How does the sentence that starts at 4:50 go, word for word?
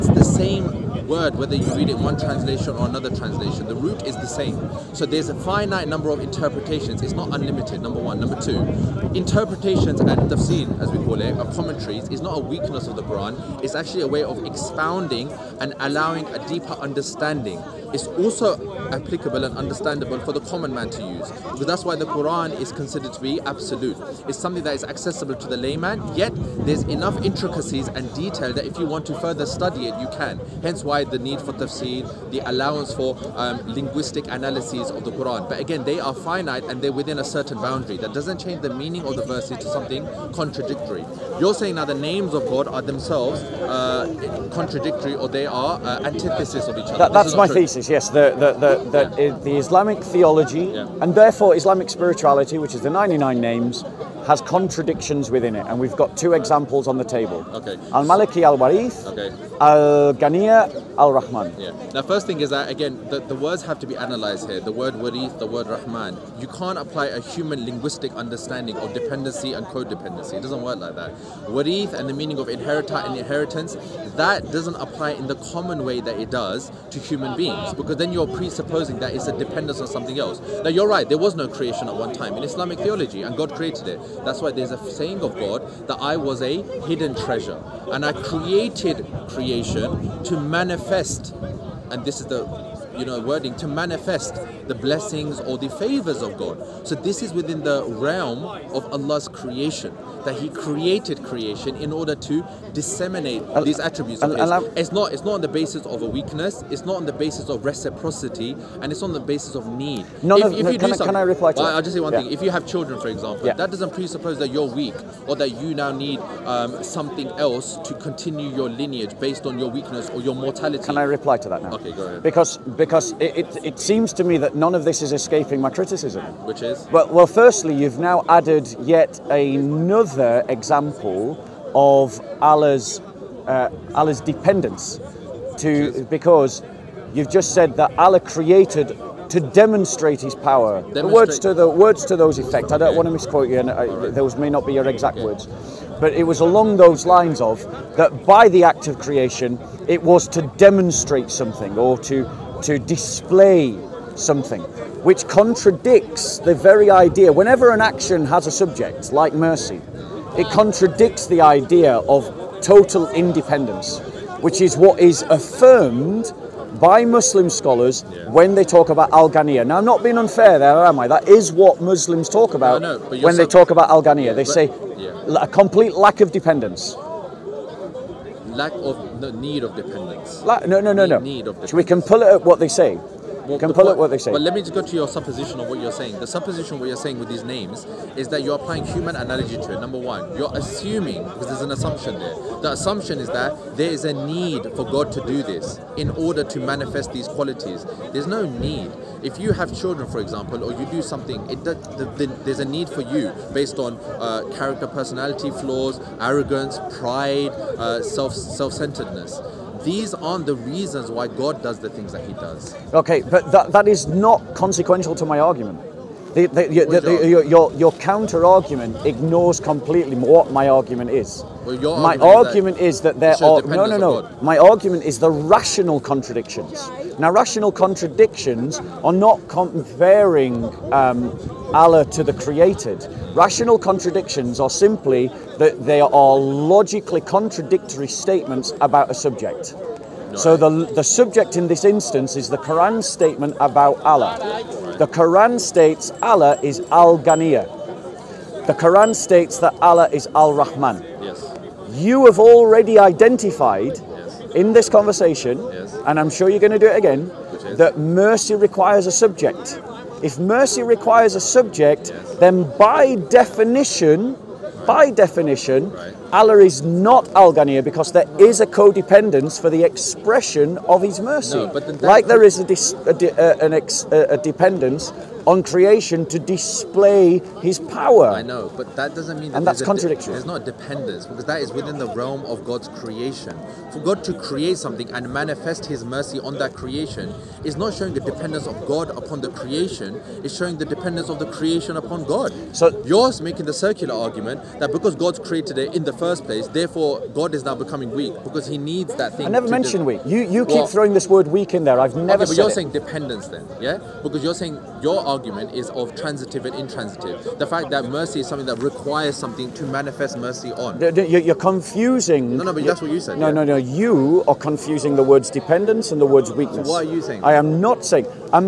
It's showing the dependence of the creation upon God.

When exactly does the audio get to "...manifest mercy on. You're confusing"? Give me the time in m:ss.
5:09.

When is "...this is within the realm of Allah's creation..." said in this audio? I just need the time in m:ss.
1:36.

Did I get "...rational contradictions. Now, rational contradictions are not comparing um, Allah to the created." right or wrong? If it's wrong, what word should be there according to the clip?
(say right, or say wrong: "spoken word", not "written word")
right.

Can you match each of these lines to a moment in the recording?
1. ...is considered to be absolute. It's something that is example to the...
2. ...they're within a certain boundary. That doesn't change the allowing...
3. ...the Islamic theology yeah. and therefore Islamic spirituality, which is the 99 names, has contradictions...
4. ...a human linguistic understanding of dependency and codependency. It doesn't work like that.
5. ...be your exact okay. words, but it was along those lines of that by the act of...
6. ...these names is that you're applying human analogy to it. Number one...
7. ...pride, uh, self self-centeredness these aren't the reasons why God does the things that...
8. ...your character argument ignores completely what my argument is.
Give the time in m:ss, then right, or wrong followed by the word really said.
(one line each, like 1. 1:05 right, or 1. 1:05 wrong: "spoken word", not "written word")
1. 0:22 wrong: "accessible", not "example"
2. 0:36 wrong: "meaning", not "allowing"
3. 0:49 right
4. 1:07 right
5. 2:24 right
6. 3:07 right
7. 3:26 right
8. 3:37 wrong: "counter", not "character".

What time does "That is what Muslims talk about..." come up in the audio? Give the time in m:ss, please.
2:51.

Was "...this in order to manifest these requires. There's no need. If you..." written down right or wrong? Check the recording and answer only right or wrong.
wrong.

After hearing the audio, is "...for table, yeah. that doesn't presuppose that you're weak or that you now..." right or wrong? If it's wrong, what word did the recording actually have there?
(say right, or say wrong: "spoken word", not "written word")
wrong: "example", not "table".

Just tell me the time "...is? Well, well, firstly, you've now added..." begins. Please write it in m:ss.
2:06.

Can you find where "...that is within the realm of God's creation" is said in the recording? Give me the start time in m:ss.
4:41.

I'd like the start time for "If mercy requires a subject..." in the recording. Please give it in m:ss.
4:20.